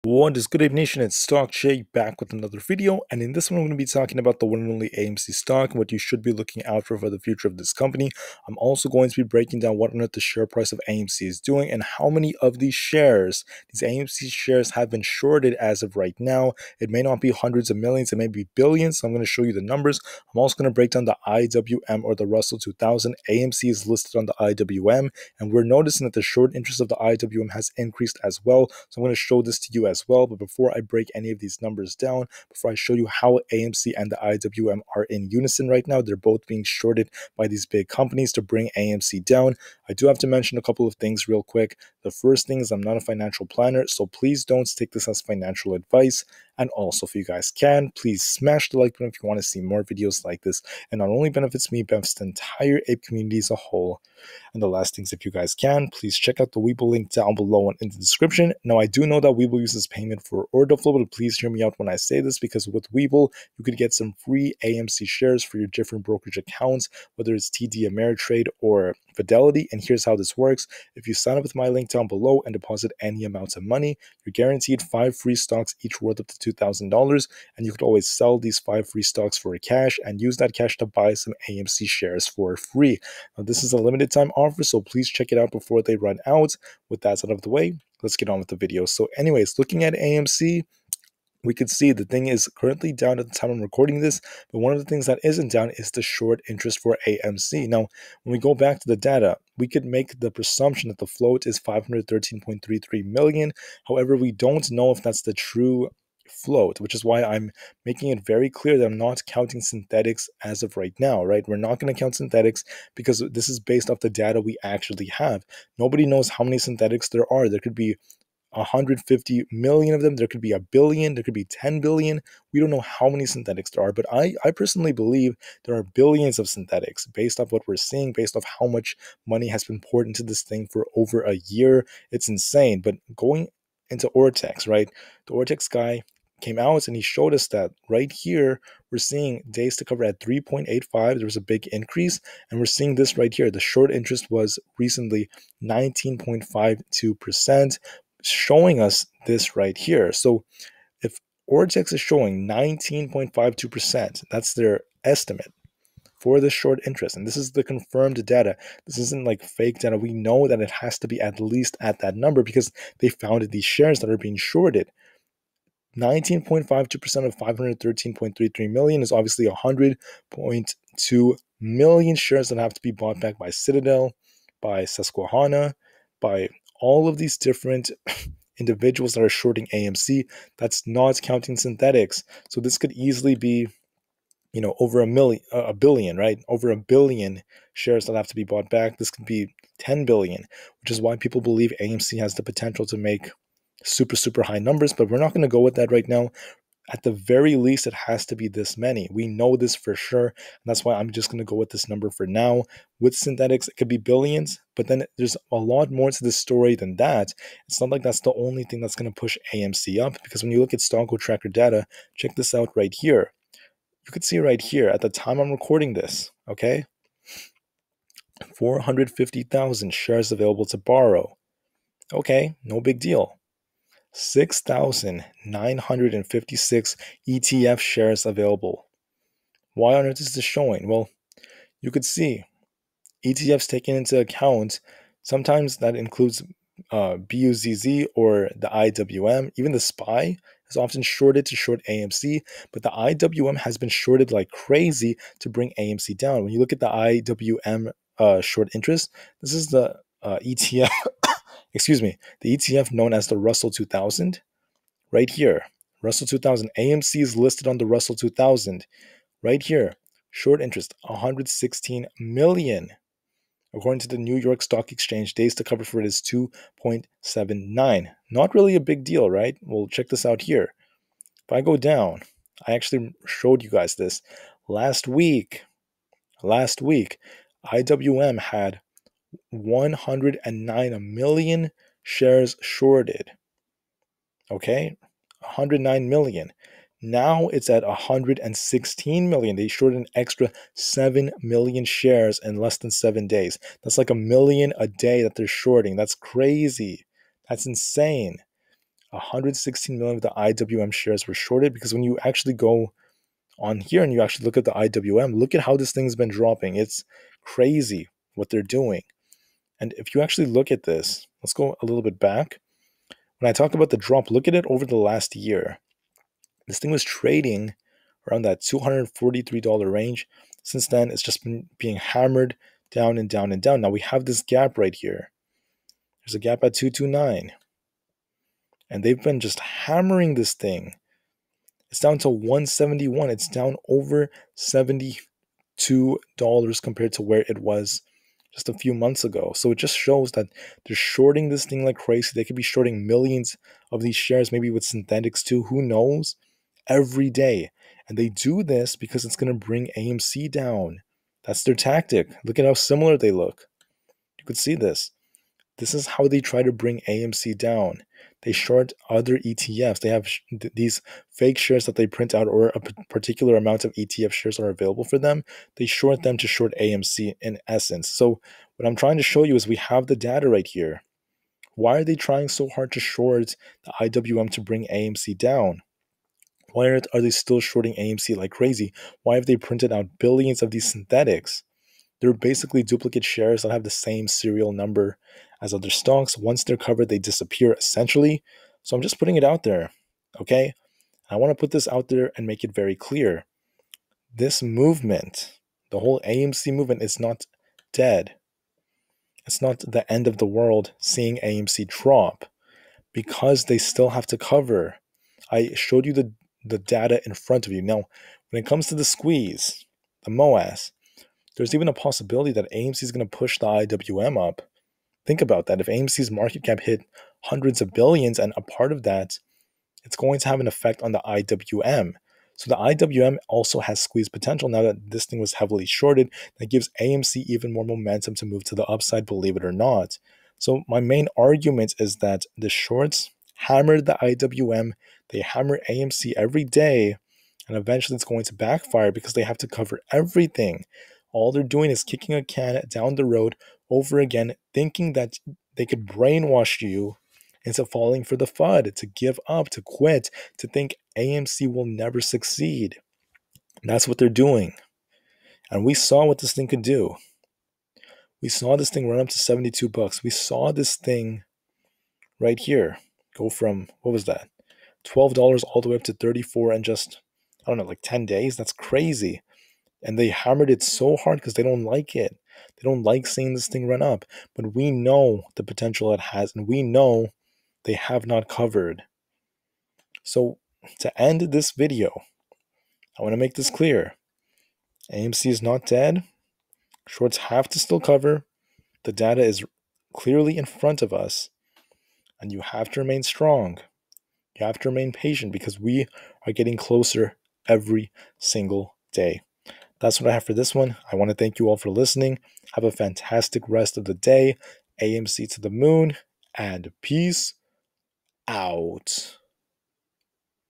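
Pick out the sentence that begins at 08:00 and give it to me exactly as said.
So, to end this video, I want to make this clear AMC is not dead.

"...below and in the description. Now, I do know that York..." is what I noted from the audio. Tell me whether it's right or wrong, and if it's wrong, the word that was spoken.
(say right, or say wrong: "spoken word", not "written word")
wrong: "Webull", not "York".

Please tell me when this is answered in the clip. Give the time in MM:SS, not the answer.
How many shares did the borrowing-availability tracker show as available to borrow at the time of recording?
03:38.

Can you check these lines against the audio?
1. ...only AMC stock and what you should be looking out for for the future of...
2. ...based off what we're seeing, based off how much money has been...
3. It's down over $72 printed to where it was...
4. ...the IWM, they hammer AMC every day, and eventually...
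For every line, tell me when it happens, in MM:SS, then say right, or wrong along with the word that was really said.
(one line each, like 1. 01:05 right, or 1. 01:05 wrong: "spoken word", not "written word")
1. 00:04 right
2. 02:07 right
3. 05:33 wrong: "compared", not "printed"
4. 07:14 right.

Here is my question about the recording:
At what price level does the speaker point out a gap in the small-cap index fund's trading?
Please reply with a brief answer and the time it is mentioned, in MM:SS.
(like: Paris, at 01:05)
229, at 05:26.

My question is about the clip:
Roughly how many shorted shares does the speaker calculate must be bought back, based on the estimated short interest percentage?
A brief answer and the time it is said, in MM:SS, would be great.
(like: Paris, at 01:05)
100.2 million, at 02:49.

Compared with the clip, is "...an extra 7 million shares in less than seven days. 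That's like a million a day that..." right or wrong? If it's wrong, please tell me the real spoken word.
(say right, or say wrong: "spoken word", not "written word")
right.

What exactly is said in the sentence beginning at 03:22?
With synthetics, it could be billions, but then there's a lot more to the story than that.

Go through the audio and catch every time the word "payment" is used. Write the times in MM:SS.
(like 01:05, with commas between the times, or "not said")
00:59.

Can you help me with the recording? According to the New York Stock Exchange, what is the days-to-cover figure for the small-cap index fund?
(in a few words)
2.79.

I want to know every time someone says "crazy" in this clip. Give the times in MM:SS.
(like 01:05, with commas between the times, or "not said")
04:04, 04:56, 05:07, 05:41, 06:18, 07:48.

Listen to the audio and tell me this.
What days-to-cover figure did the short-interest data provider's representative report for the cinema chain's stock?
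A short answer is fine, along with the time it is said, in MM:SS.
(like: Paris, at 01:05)
3.85, at 02:20.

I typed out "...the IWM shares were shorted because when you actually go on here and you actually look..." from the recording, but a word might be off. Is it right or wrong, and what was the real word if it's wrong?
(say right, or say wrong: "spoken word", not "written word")
right.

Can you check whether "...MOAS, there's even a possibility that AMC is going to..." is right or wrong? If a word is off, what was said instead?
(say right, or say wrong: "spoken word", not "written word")
right.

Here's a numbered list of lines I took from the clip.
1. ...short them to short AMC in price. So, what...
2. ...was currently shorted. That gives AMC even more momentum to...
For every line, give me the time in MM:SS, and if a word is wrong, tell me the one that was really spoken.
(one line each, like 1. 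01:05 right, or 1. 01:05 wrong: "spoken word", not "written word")
1. 06:05 wrong: "essence", not "price"
2. 07:05 wrong: "heavily", not "currently".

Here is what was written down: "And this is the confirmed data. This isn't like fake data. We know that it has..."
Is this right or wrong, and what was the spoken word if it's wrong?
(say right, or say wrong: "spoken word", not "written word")
right.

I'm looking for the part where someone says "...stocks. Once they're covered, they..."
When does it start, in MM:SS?
06:25.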